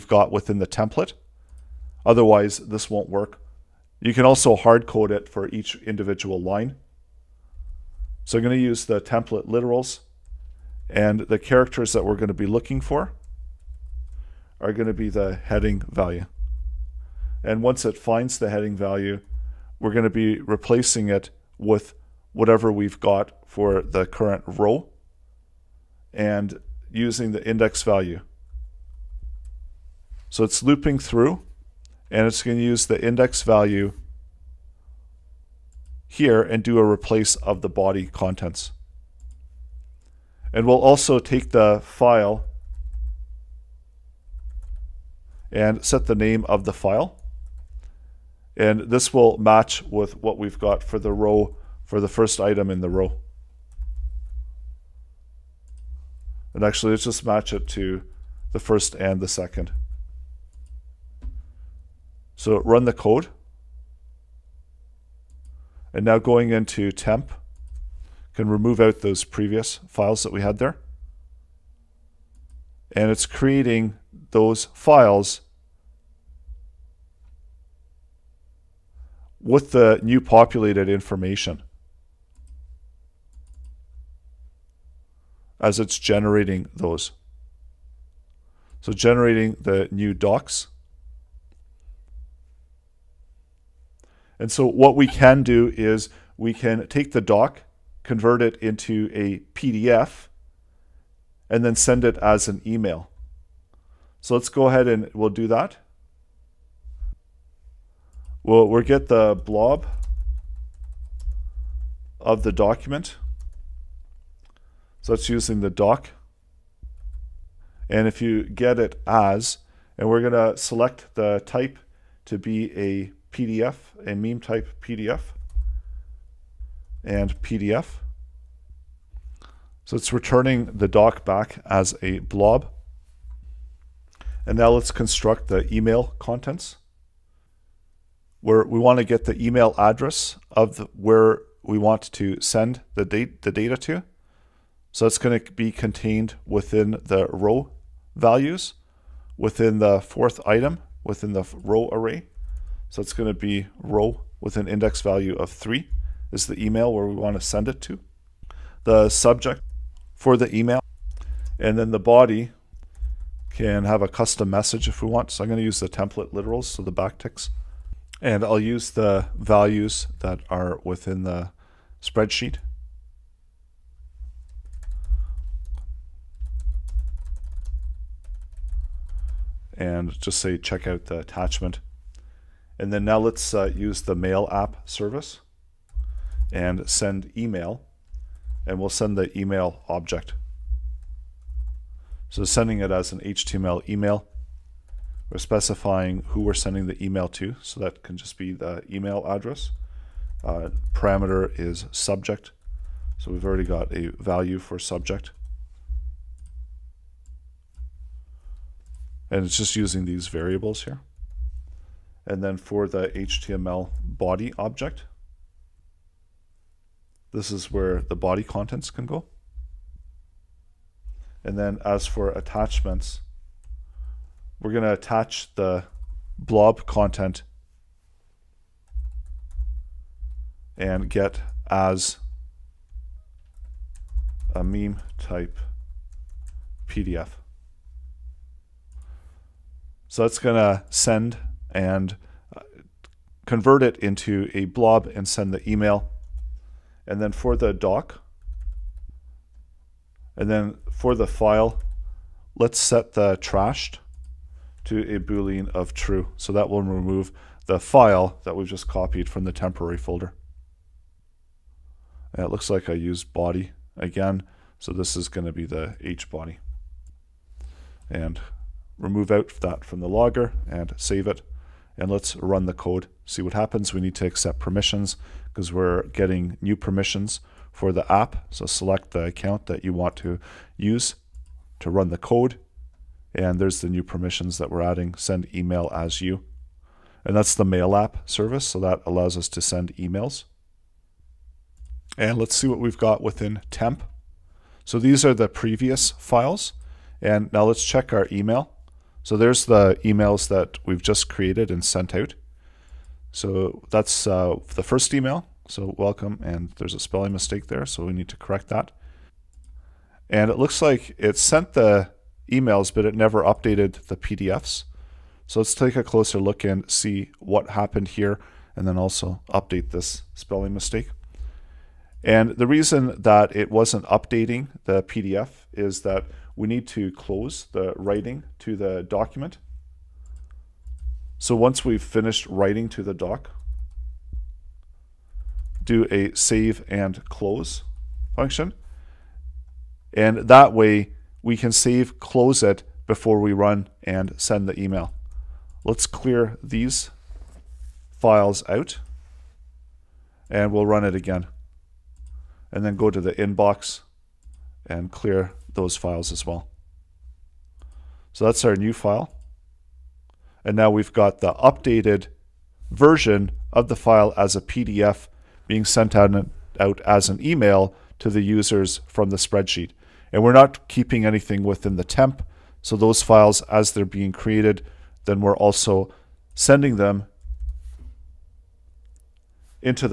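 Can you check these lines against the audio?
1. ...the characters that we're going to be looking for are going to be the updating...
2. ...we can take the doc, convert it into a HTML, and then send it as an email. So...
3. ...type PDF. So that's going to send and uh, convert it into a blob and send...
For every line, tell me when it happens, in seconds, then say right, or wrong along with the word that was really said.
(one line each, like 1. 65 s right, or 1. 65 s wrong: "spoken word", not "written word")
1. 11 s wrong: "heading", not "updating"
2. 96 s wrong: "PDF", not "HTML"
3. 235 s right.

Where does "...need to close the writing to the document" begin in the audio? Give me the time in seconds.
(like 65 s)
326 s.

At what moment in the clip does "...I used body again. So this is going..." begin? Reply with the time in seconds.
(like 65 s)
262 s.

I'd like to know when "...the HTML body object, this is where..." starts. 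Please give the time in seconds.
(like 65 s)
212 s.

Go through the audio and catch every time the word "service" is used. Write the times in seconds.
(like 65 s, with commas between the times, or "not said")
184 s, 288 s.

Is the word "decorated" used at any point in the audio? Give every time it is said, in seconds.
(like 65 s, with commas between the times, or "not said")
not said.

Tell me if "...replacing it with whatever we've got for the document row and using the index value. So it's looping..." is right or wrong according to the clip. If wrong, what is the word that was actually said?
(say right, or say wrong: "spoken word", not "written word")
wrong: "current", not "document".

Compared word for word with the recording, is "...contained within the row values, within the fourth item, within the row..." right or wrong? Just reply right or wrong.
right.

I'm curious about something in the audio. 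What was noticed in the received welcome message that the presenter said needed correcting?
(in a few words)
a spelling mistake.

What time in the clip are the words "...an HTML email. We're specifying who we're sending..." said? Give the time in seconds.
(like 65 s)
193 s.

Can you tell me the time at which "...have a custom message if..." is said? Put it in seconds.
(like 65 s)
163 s.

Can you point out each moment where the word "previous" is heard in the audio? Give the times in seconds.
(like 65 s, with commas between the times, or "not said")
69 s, 295 s.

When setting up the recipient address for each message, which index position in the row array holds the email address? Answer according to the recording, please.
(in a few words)
3.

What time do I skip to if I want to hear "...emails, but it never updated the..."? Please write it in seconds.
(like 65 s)
312 s.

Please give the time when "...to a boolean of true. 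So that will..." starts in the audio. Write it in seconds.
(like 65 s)
254 s.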